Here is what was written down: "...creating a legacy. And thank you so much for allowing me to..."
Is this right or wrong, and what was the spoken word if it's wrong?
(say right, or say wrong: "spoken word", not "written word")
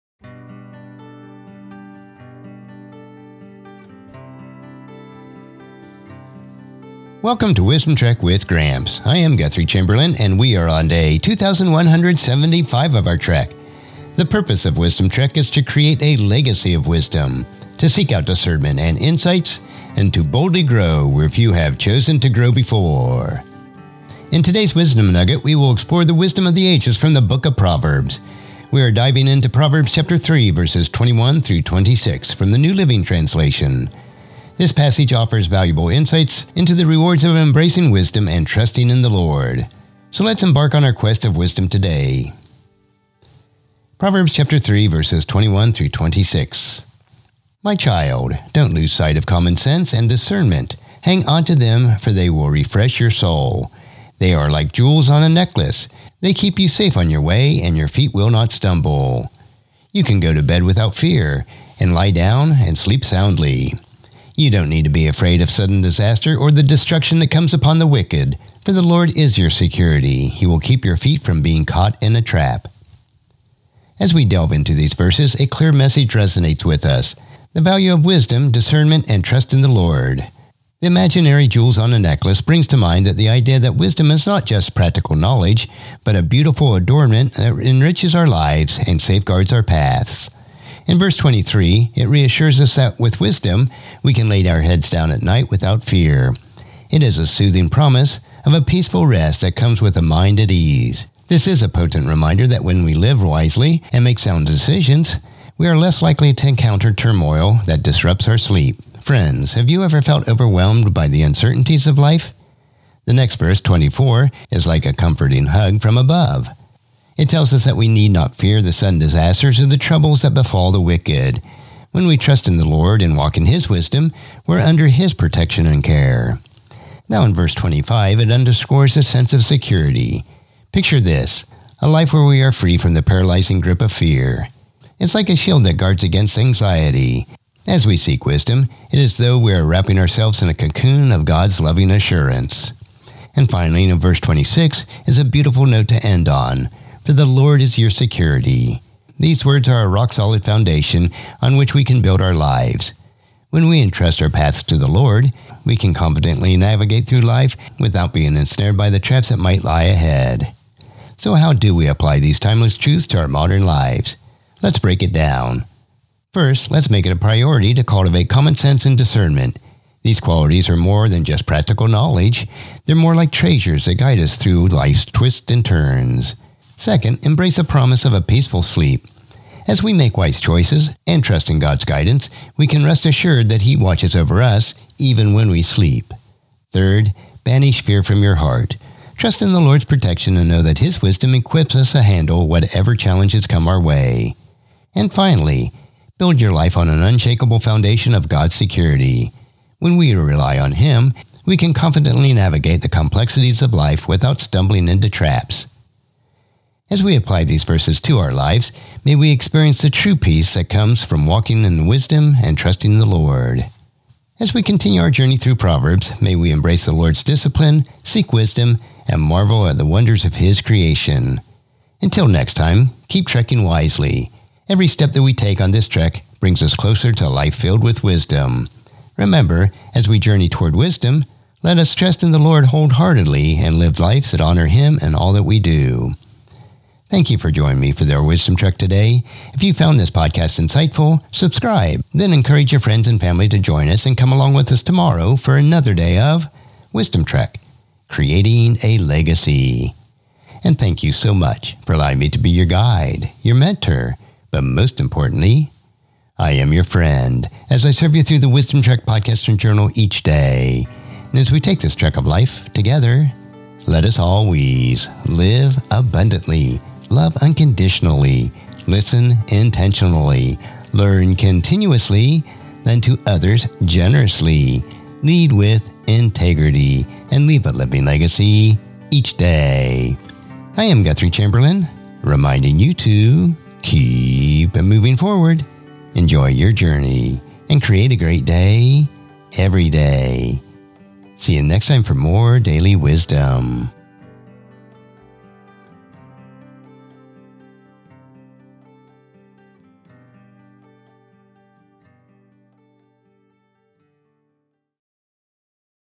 right.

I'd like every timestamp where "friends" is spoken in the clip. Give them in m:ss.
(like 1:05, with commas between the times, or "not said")
1:49, 4:02, 4:16.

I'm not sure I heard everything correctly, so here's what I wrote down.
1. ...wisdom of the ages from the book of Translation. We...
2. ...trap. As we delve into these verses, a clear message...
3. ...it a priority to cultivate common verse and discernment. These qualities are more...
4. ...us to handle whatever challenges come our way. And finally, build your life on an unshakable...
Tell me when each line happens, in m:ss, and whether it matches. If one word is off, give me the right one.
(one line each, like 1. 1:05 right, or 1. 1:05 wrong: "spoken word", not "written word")
1. 0:26 wrong: "Proverbs", not "Translation"
2. 1:12 right
3. 2:47 wrong: "sense", not "verse"
4. 3:11 right.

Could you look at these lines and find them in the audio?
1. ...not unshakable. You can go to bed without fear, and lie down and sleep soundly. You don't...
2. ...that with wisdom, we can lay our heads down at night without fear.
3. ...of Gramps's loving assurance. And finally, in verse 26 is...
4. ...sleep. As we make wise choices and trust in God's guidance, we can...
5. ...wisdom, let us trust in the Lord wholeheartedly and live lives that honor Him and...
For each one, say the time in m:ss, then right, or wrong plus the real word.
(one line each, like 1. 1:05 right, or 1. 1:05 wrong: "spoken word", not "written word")
1. 0:58 wrong: "stumble", not "unshakable"
2. 1:32 right
3. 2:21 wrong: "God", not "Gramps"
4. 2:58 right
5. 3:50 right.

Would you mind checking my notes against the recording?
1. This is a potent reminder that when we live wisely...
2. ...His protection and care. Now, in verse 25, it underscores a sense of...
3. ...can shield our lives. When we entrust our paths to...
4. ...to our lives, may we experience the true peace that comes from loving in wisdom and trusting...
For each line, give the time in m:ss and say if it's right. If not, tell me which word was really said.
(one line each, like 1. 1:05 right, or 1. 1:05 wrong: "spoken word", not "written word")
1. 1:41 right
2. 2:04 right
3. 2:31 wrong: "build", not "shield"
4. 3:28 wrong: "walking", not "loving".